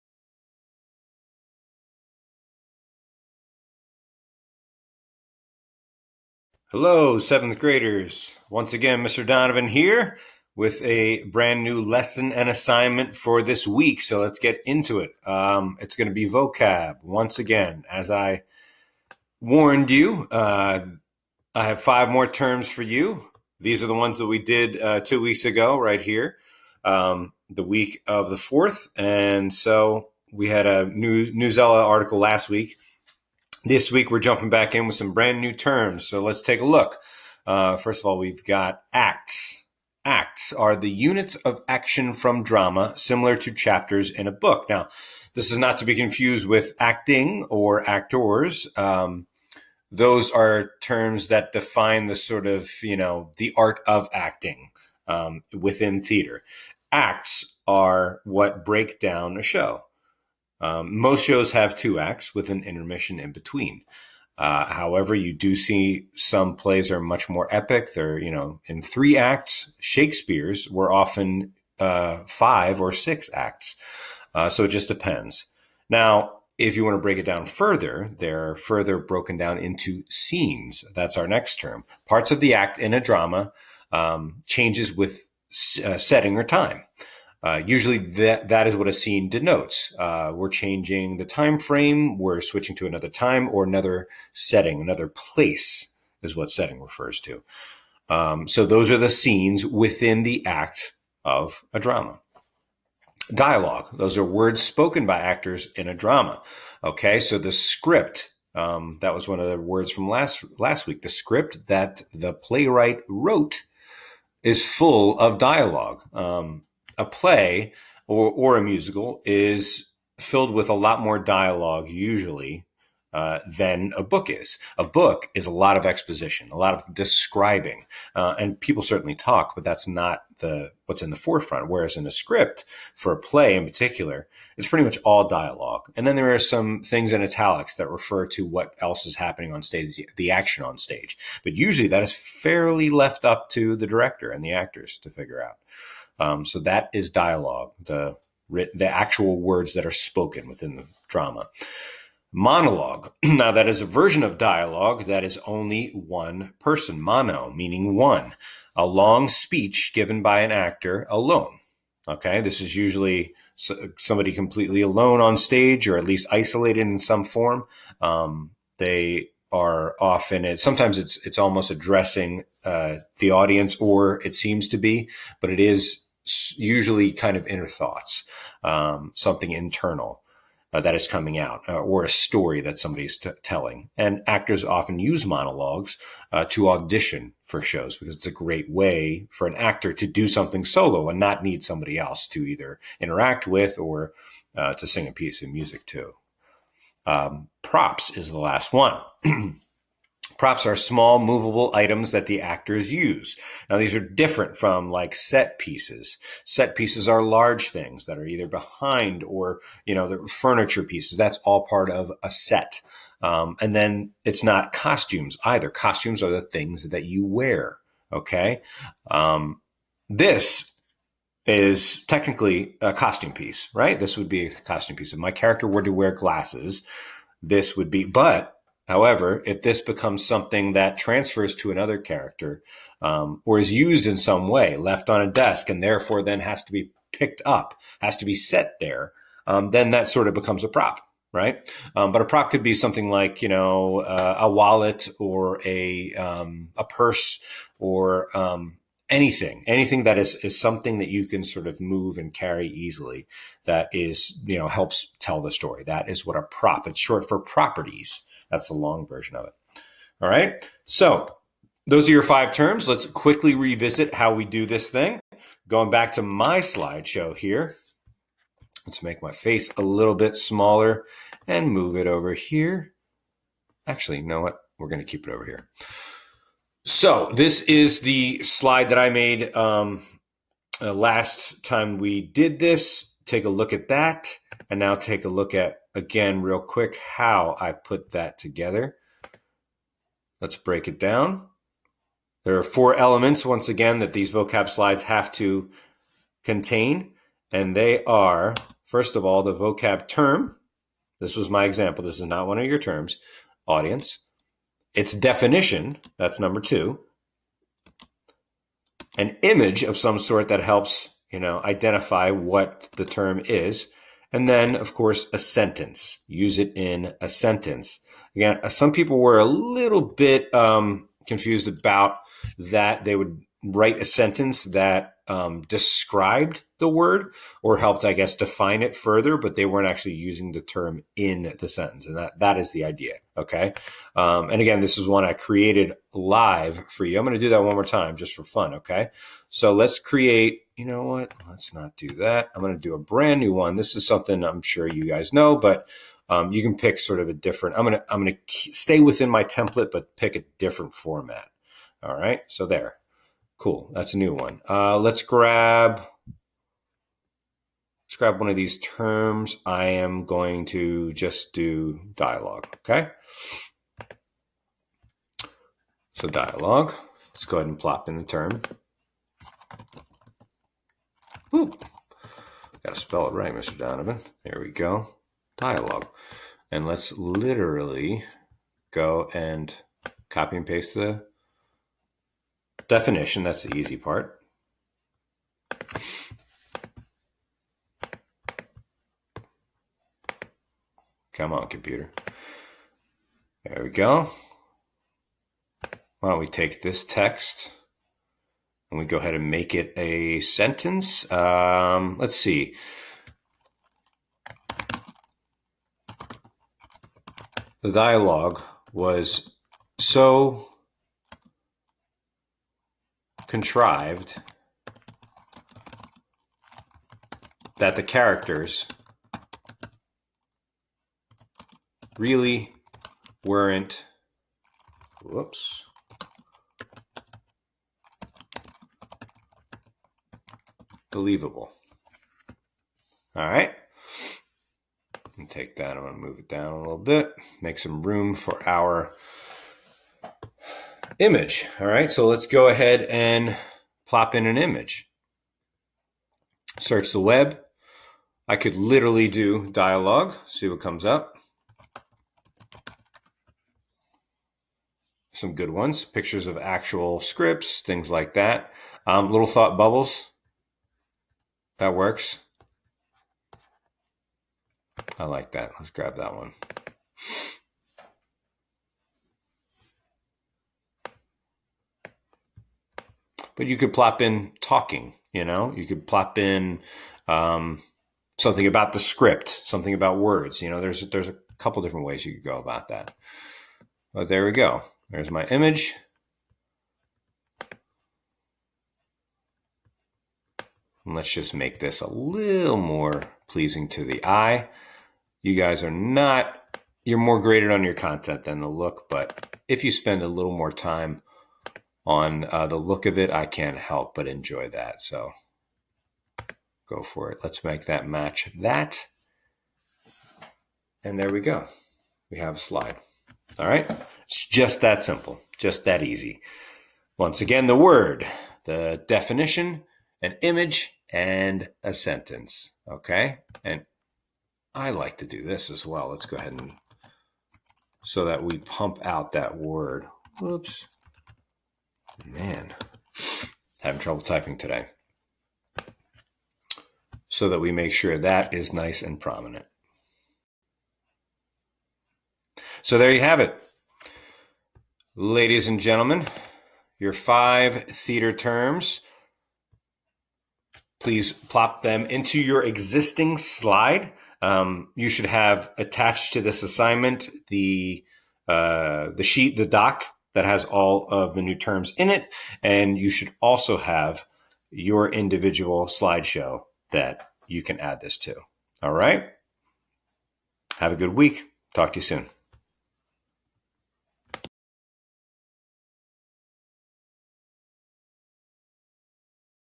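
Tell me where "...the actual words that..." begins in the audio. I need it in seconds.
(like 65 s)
148 s.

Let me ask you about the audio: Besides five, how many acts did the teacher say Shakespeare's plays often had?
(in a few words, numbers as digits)
6.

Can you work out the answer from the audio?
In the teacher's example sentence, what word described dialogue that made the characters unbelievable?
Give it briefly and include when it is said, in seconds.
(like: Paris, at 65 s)
Contrived, at 413 s.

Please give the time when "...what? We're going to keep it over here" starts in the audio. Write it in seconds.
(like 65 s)
274 s.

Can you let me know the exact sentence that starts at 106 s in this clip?
Okay, so the script, um, that was one of the words from last last week.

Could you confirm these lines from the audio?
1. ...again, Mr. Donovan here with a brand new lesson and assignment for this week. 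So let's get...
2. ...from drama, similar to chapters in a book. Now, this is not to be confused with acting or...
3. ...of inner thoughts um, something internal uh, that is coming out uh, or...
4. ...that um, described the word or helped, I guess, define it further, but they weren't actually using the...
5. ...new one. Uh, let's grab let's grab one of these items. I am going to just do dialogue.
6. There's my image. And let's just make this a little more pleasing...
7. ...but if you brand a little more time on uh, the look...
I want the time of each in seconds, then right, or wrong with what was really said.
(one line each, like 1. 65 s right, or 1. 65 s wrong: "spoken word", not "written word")
1. 8 s right
2. 42 s right
3. 177 s right
4. 324 s right
5. 354 s wrong: "terms", not "items"
6. 485 s right
7. 499 s wrong: "spend", not "brand".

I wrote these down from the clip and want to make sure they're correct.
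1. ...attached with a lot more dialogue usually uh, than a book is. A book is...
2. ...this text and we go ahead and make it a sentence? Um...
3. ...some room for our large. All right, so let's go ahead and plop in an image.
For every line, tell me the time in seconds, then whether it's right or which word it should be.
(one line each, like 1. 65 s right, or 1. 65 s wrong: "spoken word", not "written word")
1. 120 s wrong: "filled", not "attached"
2. 396 s right
3. 437 s wrong: "image", not "large".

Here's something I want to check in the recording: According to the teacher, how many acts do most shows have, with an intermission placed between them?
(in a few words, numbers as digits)
2.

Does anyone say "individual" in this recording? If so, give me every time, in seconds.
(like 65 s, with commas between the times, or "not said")
565 s.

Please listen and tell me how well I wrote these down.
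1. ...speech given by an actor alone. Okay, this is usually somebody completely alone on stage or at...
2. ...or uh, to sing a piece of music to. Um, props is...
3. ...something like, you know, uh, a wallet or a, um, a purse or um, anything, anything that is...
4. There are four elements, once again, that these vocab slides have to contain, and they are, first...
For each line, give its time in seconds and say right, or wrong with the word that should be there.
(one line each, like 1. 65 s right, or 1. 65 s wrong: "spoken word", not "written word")
1. 159 s right
2. 193 s right
3. 242 s right
4. 292 s right.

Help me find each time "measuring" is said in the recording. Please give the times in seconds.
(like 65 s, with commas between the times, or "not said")
not said.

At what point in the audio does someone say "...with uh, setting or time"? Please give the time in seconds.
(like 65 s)
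84 s.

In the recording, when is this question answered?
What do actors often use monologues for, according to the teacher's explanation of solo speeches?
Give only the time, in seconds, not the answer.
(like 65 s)
186 s.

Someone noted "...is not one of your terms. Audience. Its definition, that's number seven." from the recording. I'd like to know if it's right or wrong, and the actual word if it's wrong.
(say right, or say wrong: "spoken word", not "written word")
wrong: "two", not "seven".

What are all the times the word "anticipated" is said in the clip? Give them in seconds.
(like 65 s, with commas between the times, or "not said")
not said.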